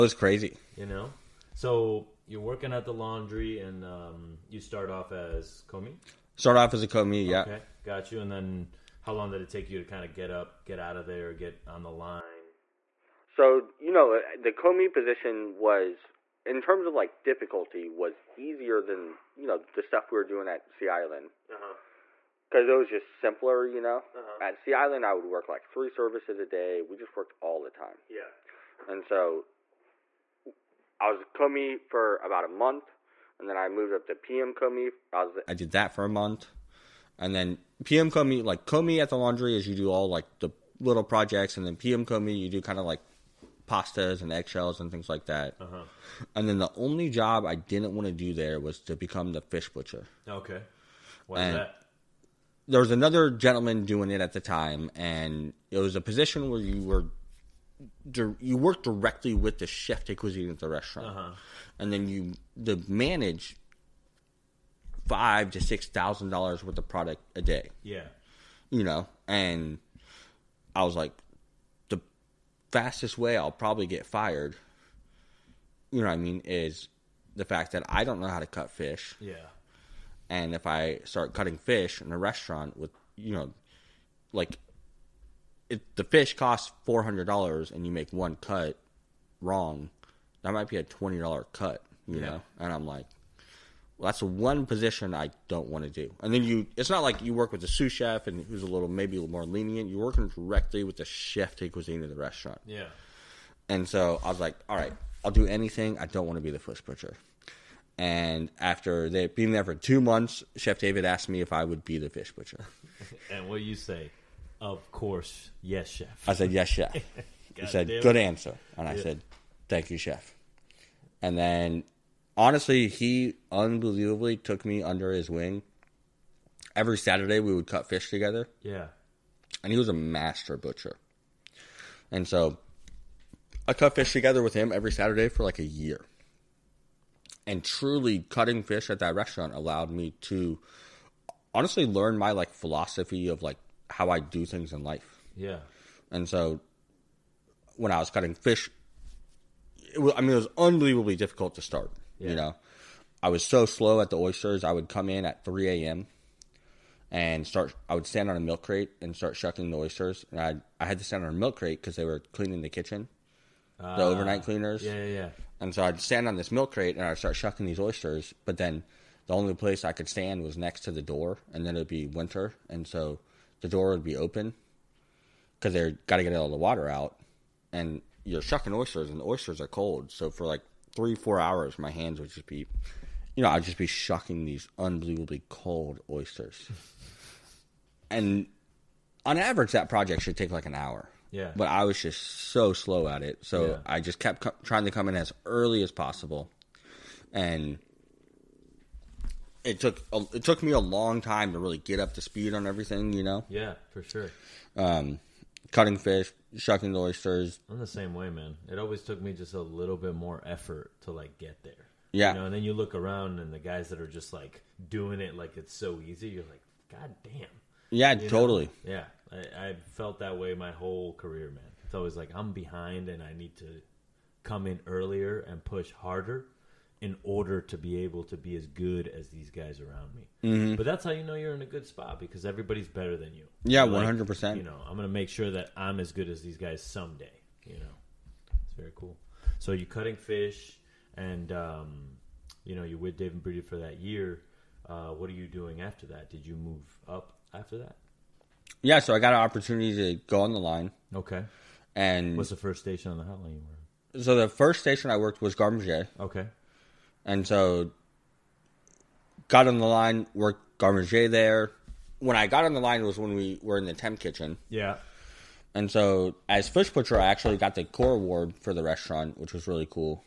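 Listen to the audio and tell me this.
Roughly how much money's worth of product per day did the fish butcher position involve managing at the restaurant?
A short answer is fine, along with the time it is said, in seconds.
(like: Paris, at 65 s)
5,000 to 6,000 dollars, at 65 s.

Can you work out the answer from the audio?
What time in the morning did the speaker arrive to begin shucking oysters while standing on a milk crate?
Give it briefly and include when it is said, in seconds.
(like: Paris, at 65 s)
3 a.m., at 155 s.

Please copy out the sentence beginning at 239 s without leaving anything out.
So you're cutting fish, and um, you know you're with David Breeden for that year.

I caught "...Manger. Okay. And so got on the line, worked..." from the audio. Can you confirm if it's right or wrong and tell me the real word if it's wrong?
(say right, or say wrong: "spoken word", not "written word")
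right.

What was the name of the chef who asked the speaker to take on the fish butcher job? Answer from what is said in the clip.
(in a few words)
Chef David.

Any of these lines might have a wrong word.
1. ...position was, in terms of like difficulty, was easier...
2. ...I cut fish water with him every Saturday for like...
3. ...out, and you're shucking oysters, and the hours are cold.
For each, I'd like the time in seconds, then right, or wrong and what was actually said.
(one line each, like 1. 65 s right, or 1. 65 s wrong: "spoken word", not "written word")
1. 14 s right
2. 133 s wrong: "together", not "water"
3. 176 s wrong: "oysters", not "hours".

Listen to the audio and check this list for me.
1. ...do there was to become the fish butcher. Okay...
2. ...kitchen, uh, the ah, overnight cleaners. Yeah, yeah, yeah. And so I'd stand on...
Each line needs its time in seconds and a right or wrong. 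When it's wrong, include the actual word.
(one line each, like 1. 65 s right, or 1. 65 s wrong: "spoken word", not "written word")
1. 48 s right
2. 162 s right.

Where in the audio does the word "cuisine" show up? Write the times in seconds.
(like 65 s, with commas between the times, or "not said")
60 s, 101 s.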